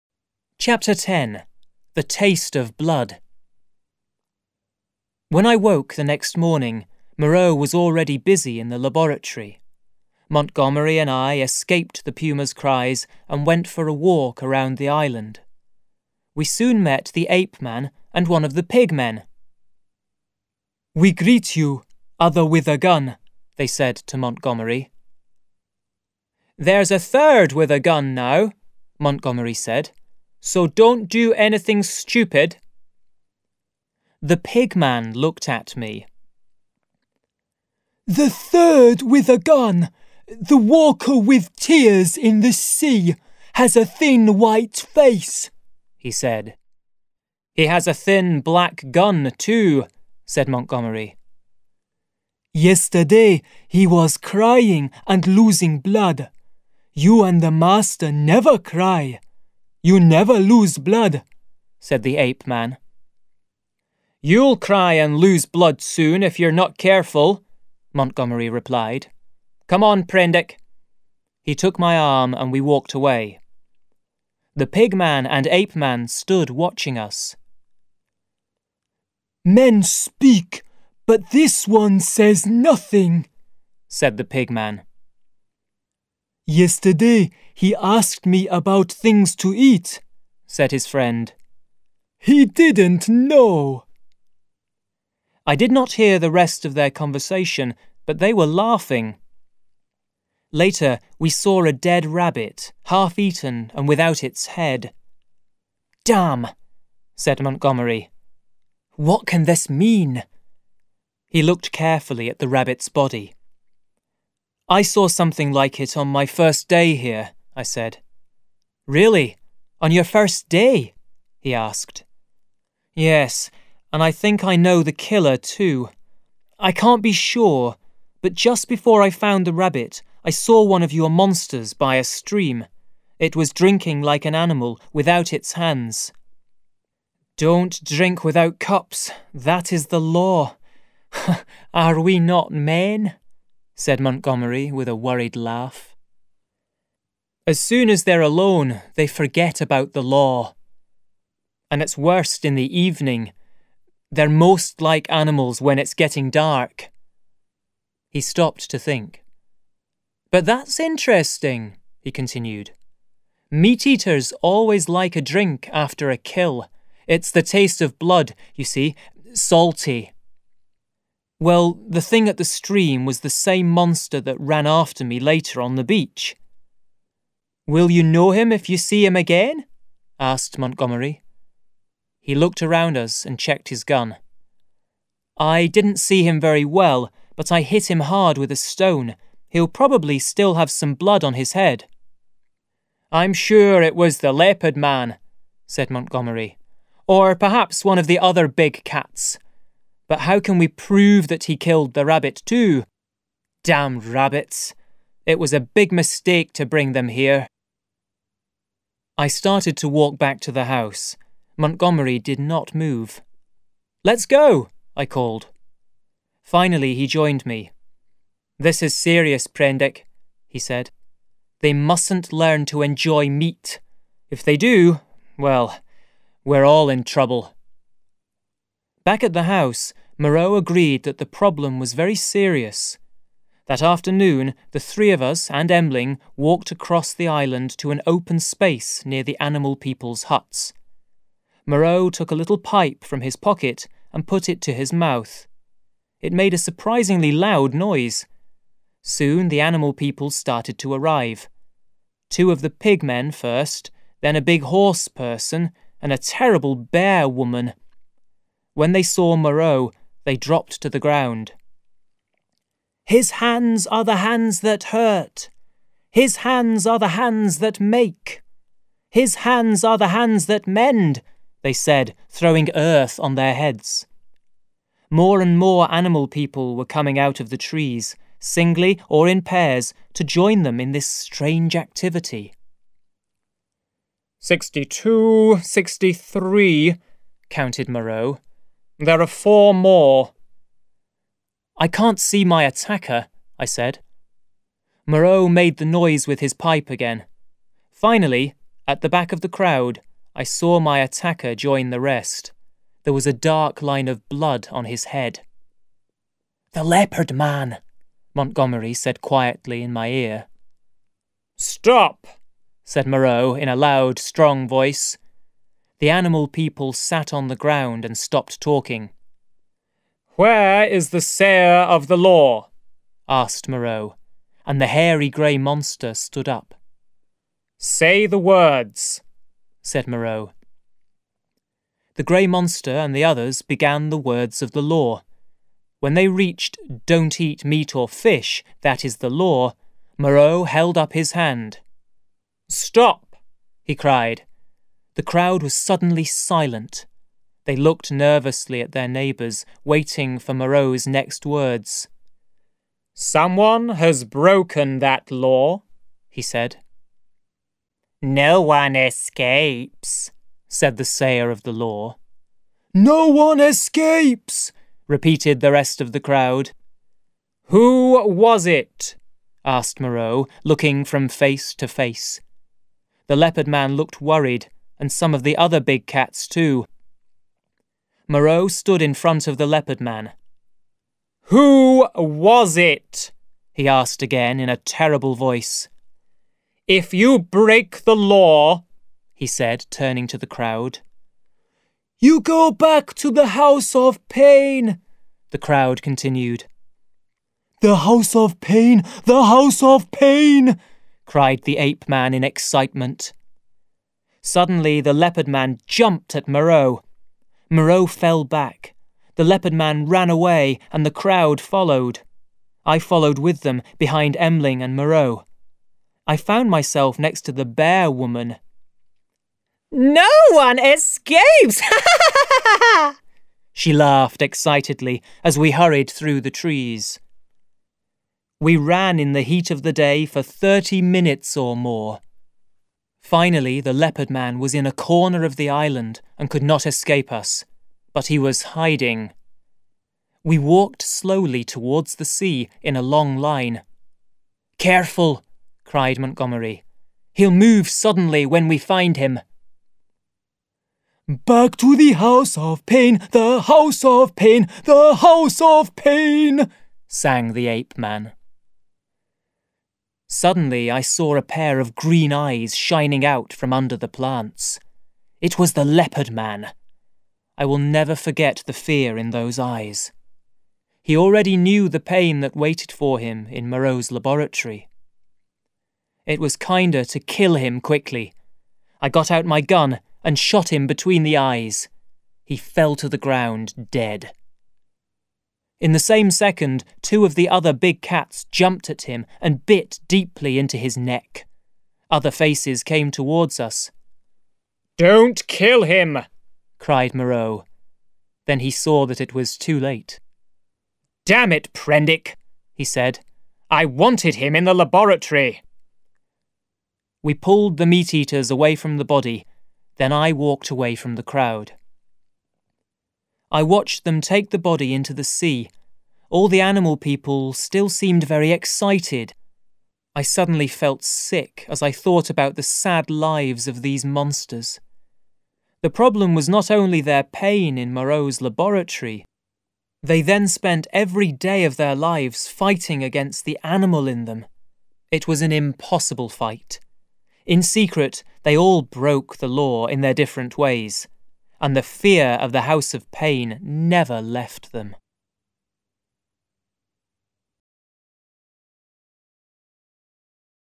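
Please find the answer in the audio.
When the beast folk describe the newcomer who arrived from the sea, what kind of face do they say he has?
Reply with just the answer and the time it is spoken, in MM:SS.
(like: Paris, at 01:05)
thin white face, at 00:43.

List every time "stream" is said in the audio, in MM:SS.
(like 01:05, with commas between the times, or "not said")
02:12, 02:52.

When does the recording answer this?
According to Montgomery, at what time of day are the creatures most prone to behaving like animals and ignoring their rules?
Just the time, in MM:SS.
02:32.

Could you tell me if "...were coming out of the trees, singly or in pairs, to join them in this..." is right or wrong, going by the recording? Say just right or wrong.
right.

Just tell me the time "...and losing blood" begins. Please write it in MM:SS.
00:55.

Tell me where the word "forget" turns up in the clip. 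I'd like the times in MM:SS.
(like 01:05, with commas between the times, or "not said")
02:29, 07:48.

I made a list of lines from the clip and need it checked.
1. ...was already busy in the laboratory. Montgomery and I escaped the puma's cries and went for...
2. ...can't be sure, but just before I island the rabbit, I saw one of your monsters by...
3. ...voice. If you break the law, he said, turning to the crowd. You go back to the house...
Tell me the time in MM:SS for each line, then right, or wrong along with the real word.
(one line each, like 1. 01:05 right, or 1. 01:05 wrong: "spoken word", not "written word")
1. 00:07 right
2. 02:06 wrong: "found", not "island"
3. 06:25 right.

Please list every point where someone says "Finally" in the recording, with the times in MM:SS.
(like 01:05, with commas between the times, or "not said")
03:36, 04:57, 07:13.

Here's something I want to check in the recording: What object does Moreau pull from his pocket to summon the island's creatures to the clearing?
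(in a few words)
a little pipe.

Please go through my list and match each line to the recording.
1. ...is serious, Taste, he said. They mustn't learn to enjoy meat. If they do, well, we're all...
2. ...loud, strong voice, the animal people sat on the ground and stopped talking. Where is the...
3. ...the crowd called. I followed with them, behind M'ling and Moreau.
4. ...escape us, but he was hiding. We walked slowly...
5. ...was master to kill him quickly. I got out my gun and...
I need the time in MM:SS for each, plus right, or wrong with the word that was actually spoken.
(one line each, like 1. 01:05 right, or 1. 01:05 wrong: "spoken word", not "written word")
1. 03:38 wrong: "Prendick", not "Taste"
2. 05:13 right
3. 06:51 wrong: "followed", not "called"
4. 07:16 right
5. 07:56 wrong: "kinder", not "master".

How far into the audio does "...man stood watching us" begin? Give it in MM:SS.
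01:15.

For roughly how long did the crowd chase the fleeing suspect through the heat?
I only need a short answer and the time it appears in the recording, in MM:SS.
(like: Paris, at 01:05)
30 minutes, at 07:10.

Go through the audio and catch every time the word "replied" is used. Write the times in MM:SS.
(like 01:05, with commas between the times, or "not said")
01:08.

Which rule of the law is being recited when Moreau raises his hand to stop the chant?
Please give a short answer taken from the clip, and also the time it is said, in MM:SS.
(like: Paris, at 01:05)
don't eat meat or fish, at 05:37.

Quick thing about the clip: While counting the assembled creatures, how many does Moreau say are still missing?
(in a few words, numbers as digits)
4.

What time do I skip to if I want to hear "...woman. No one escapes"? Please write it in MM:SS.
06:58.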